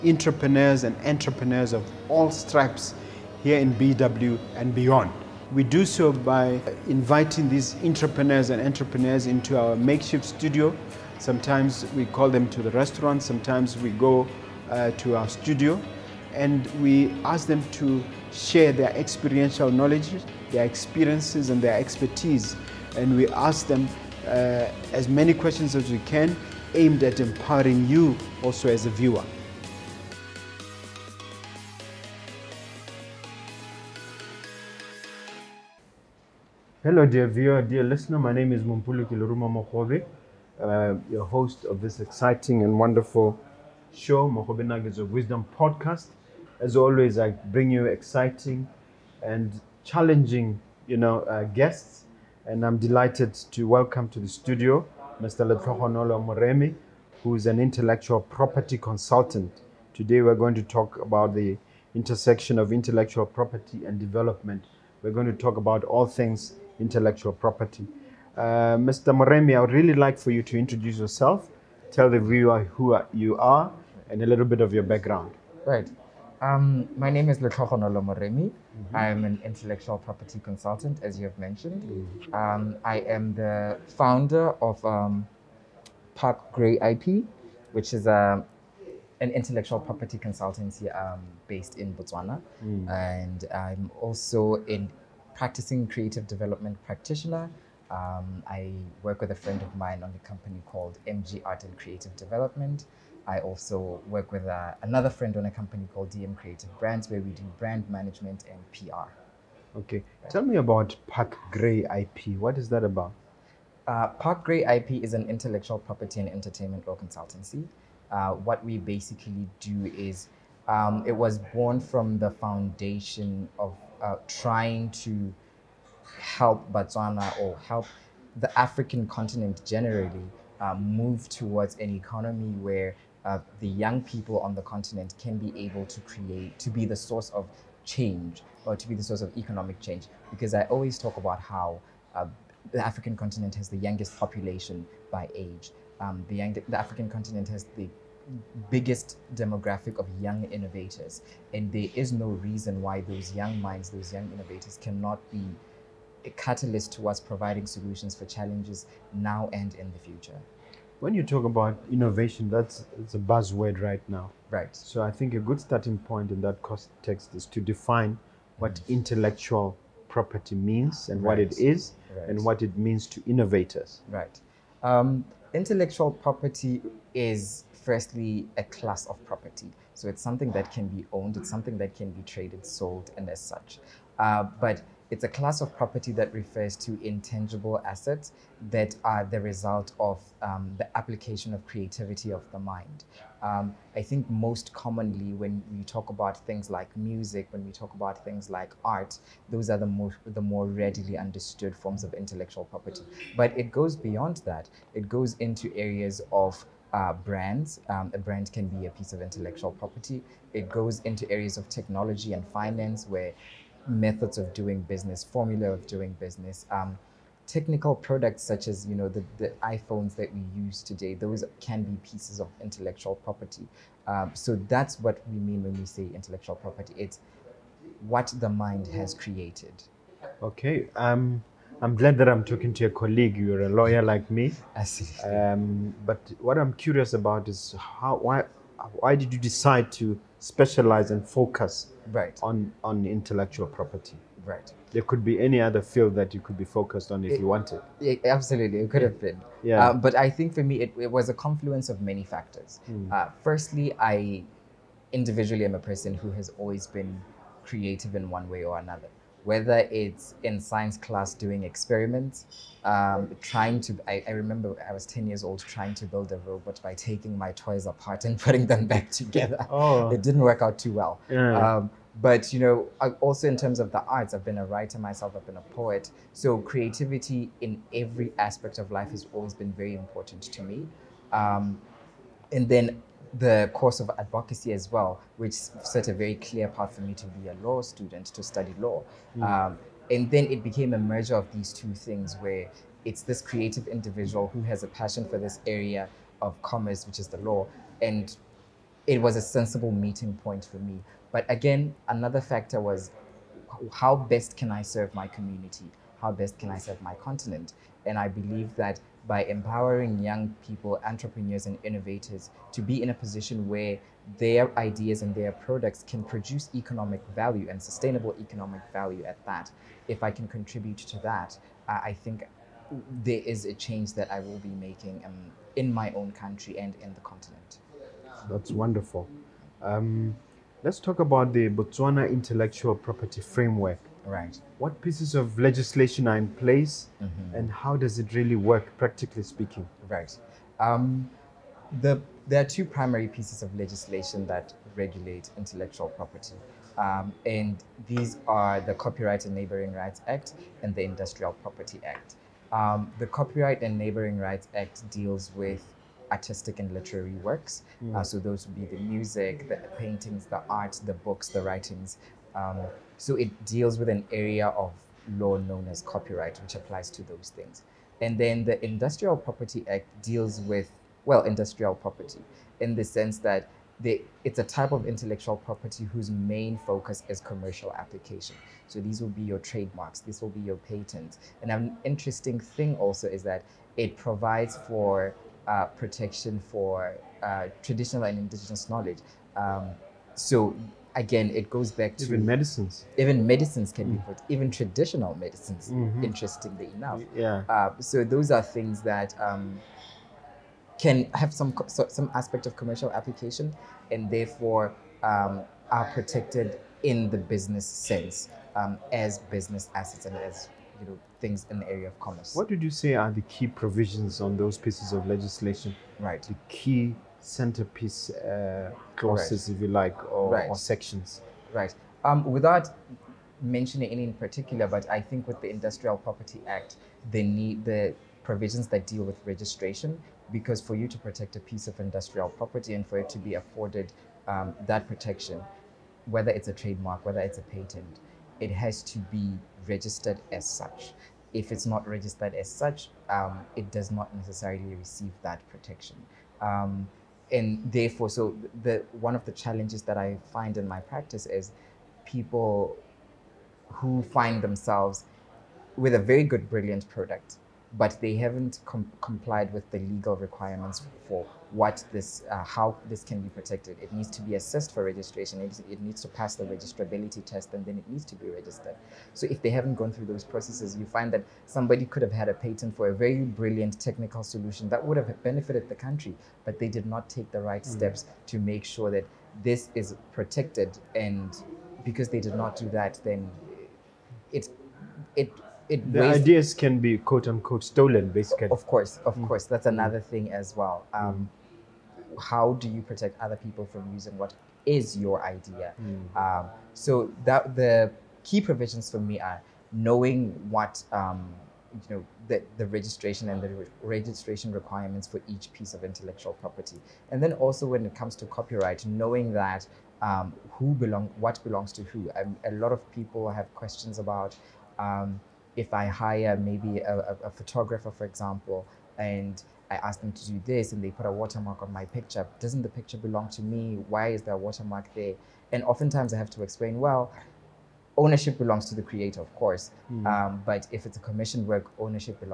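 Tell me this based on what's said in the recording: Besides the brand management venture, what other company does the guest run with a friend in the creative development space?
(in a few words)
MG Art and Creative Development.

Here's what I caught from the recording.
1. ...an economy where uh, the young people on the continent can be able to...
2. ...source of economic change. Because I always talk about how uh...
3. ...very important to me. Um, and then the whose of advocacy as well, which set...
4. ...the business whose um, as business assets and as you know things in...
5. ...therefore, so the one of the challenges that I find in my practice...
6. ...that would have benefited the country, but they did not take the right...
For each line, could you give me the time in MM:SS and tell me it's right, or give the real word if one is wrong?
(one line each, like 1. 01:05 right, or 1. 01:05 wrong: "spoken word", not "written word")
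1. 02:11 right
2. 02:19 right
3. 04:39 wrong: "course", not "whose"
4. 06:47 wrong: "sense", not "whose"
5. 07:27 right
6. 07:54 right.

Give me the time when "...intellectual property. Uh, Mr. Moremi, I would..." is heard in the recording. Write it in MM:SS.
01:06.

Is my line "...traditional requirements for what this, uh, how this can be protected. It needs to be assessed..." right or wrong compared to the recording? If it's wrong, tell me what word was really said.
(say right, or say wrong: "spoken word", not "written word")
wrong: "legal", not "traditional".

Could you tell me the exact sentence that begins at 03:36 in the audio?
Um, technical products such as you know the, the iPhones that we use today, those can be pieces of intellectual property.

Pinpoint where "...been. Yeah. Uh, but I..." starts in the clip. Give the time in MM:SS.
04:09.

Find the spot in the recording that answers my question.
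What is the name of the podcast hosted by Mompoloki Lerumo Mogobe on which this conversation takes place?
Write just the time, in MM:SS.
00:44.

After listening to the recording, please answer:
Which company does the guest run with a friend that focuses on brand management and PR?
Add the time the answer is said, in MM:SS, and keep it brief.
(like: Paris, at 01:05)
DM Creative Brands, at 01:46.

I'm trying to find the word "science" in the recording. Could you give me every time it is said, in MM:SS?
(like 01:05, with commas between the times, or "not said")
04:20.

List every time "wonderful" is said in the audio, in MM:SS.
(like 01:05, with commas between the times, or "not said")
00:42, 05:28.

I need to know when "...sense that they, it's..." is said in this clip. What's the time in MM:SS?
06:13.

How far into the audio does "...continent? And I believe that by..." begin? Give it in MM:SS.
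05:07.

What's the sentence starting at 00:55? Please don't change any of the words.
Letlhogonolo Moremi, who is an intellectual property consultant.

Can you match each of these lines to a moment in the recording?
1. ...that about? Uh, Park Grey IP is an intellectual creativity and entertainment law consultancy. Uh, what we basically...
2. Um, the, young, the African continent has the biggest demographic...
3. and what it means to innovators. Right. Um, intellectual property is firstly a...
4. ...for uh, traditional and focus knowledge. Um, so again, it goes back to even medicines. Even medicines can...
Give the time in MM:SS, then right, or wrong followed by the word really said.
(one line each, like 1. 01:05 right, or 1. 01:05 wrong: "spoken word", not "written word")
1. 01:52 wrong: "property", not "creativity"
2. 02:25 right
3. 02:52 right
4. 06:26 wrong: "indigenous", not "focus".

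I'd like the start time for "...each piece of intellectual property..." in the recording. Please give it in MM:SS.
08:25.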